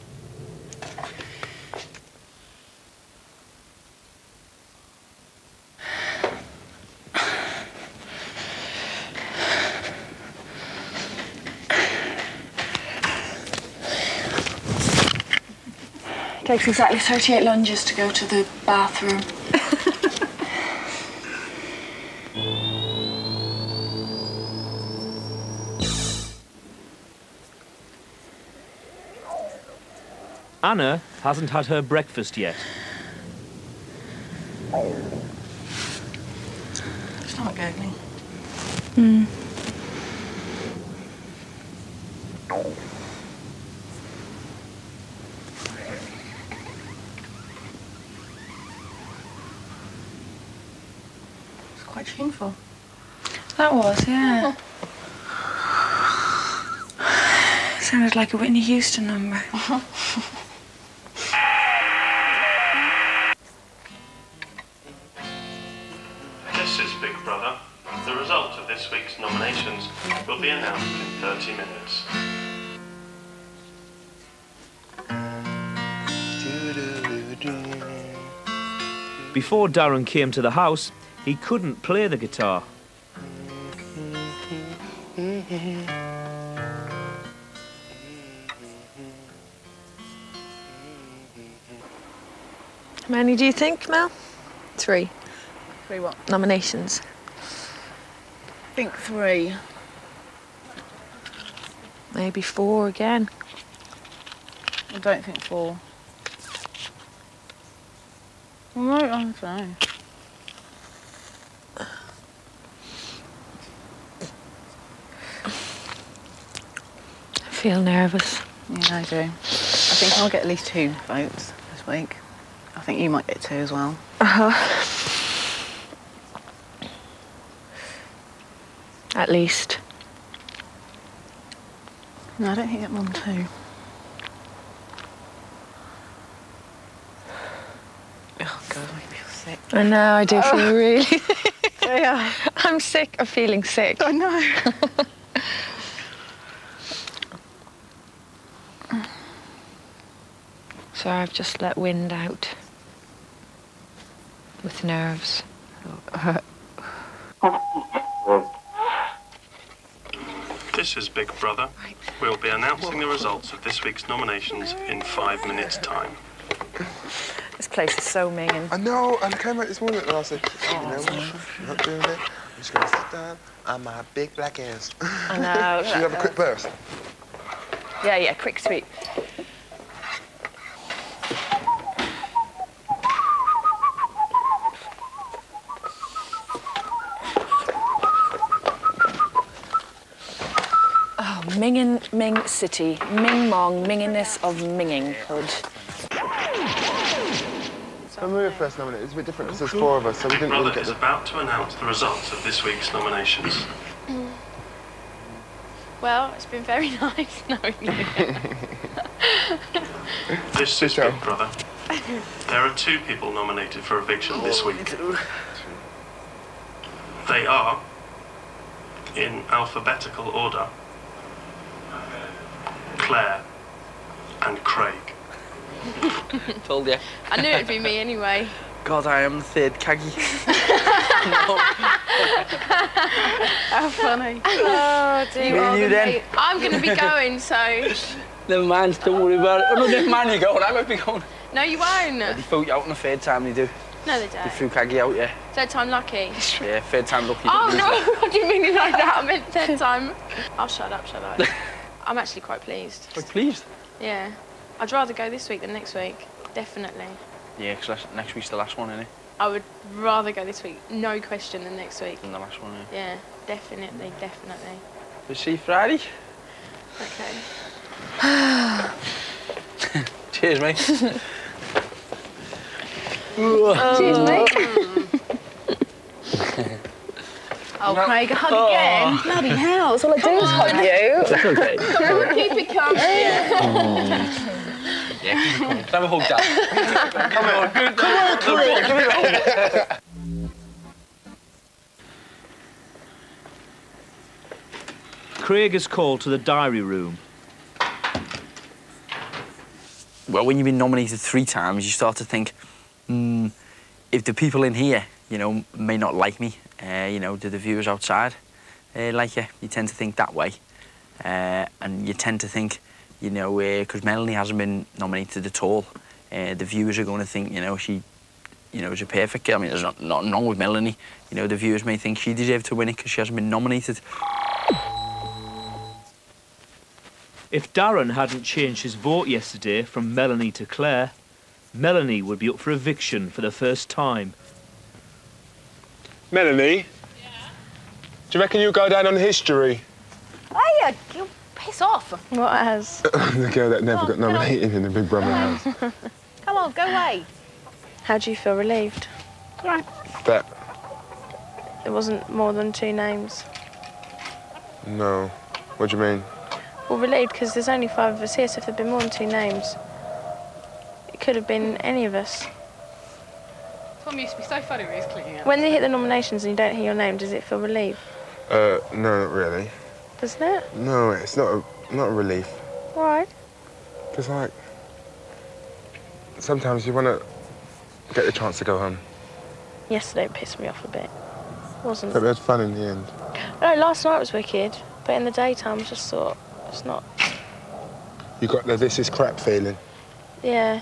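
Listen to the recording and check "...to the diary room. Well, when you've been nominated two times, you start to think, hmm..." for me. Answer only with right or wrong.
wrong.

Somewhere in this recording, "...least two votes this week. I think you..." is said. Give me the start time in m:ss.
2:00.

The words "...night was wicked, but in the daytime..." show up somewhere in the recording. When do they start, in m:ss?
6:24.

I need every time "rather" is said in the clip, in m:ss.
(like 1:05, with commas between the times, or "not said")
4:14, 4:19.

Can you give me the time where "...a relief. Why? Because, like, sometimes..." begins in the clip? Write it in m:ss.
6:12.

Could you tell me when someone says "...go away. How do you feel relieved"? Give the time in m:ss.
5:46.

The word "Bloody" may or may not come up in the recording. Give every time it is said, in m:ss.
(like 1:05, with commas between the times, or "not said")
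4:39.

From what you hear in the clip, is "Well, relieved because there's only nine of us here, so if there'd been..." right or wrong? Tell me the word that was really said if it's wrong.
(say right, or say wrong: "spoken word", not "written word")
wrong: "five", not "nine".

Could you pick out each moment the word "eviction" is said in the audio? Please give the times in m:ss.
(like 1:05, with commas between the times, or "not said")
3:33, 5:32.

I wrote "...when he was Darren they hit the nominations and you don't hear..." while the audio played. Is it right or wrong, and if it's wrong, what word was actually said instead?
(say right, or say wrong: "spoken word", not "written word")
wrong: "When", not "Darren".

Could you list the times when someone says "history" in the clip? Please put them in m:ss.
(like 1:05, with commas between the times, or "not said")
5:39.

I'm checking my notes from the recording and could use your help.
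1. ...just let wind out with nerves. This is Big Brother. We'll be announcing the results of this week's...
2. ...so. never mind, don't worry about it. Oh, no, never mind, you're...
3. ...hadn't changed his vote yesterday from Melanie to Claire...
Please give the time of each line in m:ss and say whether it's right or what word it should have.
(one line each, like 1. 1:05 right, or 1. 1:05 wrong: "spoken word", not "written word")
1. 2:31 right
2. 3:57 right
3. 5:28 right.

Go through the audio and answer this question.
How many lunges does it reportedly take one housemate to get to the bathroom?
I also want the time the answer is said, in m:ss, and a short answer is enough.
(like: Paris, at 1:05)
38, at 0:16.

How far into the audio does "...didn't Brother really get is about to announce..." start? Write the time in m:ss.
3:20.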